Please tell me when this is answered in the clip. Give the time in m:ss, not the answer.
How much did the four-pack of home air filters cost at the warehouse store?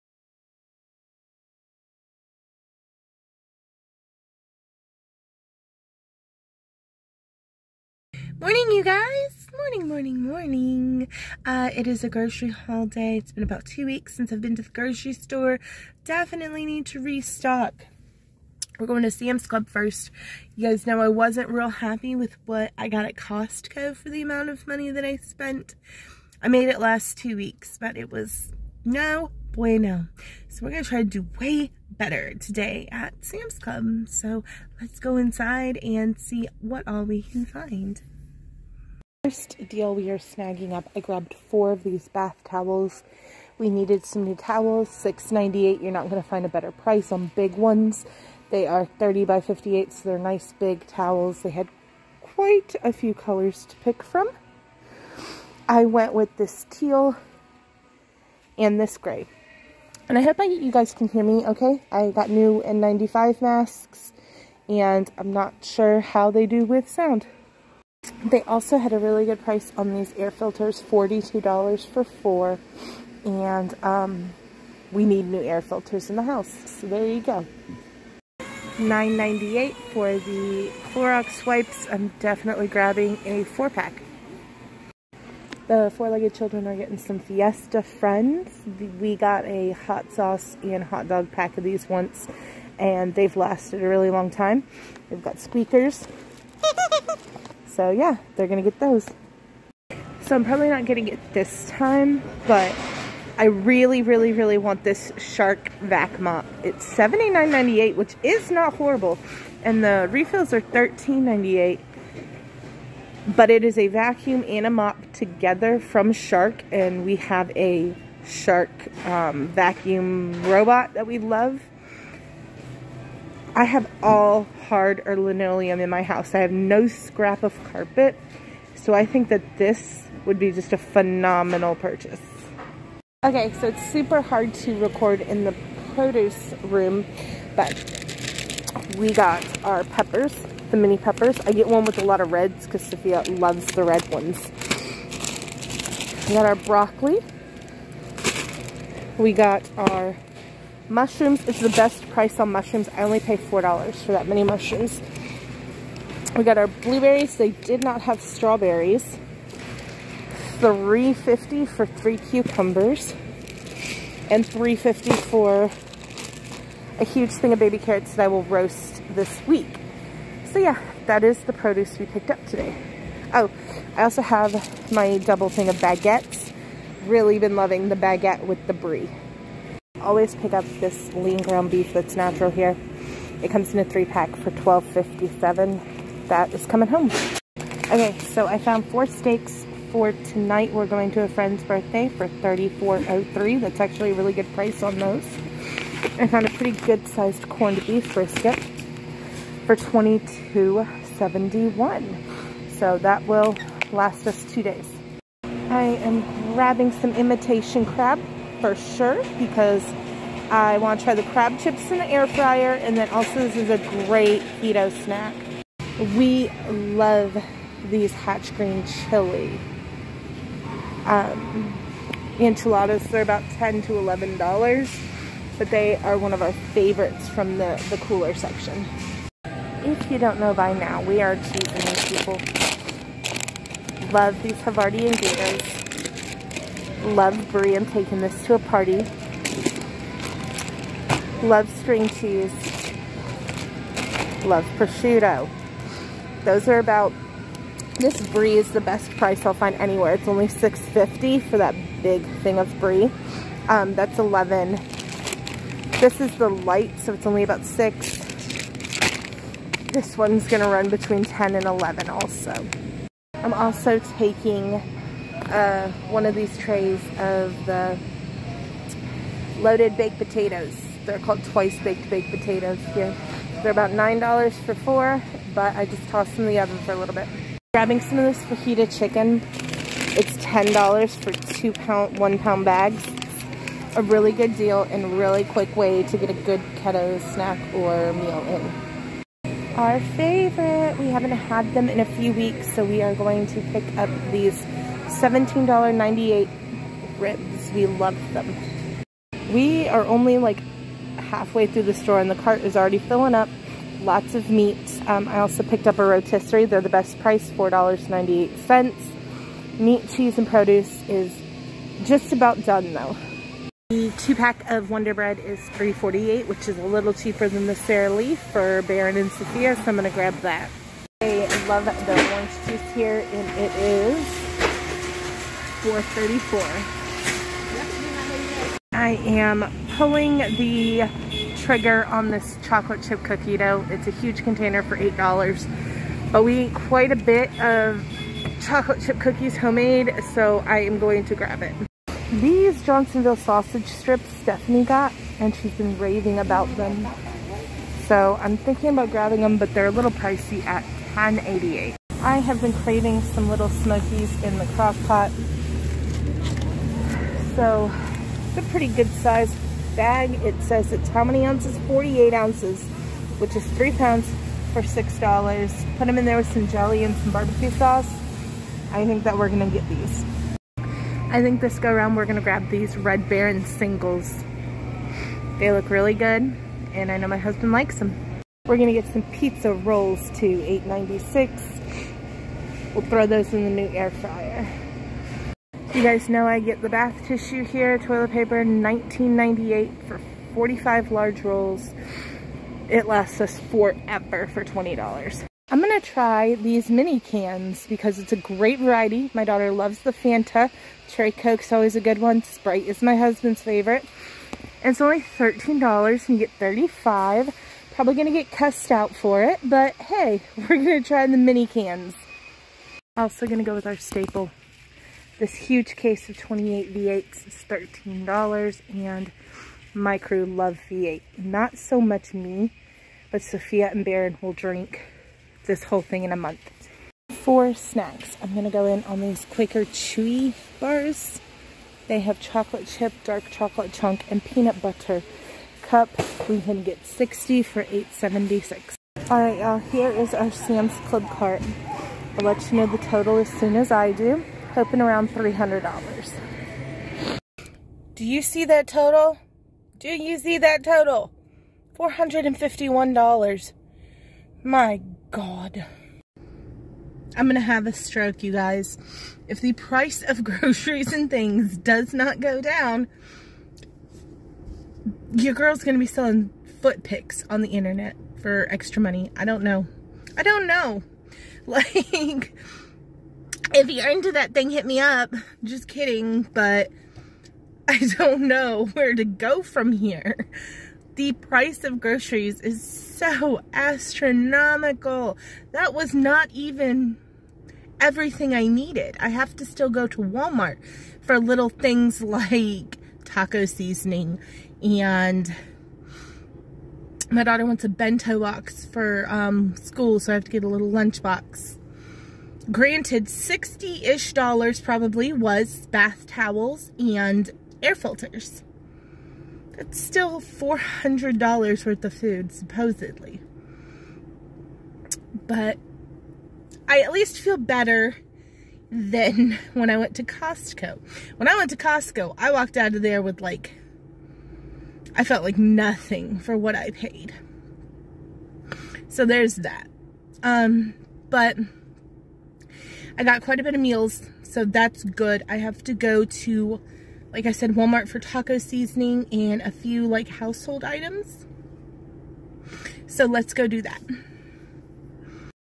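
1:10.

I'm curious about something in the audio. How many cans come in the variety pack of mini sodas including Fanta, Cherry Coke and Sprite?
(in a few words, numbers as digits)
35.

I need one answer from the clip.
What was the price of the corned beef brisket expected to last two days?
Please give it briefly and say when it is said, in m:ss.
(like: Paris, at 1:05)
$22.71, at 3:19.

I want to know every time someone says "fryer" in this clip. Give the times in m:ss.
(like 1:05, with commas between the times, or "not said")
3:32, 6:24.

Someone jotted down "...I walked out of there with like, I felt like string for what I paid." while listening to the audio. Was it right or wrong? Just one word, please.
wrong.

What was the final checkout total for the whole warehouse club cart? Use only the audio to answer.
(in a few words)
$451.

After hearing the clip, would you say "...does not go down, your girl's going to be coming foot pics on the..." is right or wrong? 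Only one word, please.
wrong.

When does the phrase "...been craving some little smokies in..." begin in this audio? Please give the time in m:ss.
5:52.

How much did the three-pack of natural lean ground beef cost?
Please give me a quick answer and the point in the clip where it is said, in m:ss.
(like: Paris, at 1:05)
$12.57, at 3:04.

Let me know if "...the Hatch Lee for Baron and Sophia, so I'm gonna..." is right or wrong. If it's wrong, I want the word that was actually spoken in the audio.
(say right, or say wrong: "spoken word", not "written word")
wrong: "Sara", not "Hatch".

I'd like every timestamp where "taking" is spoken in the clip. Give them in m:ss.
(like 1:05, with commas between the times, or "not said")
3:57, 4:24.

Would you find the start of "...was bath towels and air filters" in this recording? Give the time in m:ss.
8:25.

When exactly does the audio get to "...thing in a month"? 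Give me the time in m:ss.
7:06.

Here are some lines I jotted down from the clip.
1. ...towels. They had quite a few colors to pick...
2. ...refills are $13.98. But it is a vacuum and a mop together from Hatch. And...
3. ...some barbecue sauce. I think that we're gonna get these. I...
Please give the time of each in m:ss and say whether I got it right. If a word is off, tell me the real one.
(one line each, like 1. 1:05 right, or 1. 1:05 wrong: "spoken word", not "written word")
1. 0:50 right
2. 1:50 wrong: "Shark", not "Hatch"
3. 6:07 right.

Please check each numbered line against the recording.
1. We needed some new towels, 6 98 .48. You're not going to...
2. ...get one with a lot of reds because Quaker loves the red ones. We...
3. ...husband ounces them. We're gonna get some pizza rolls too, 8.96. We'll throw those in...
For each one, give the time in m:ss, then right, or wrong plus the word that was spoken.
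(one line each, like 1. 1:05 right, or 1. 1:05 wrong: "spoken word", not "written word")
1. 0:43 wrong: "98", not "48"
2. 2:21 wrong: "Sophia", not "Quaker"
3. 6:17 wrong: "likes", not "ounces".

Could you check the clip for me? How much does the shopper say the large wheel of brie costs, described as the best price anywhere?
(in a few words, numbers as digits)
$6.50.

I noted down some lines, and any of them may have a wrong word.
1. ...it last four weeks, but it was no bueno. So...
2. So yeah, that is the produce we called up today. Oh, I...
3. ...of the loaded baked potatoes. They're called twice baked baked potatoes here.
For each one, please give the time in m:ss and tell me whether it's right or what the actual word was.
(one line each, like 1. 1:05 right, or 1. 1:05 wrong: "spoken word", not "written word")
1. 0:26 wrong: "two", not "four"
2. 2:50 wrong: "picked", not "called"
3. 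4:27 right.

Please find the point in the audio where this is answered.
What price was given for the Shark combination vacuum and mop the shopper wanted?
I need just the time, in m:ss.
1:46.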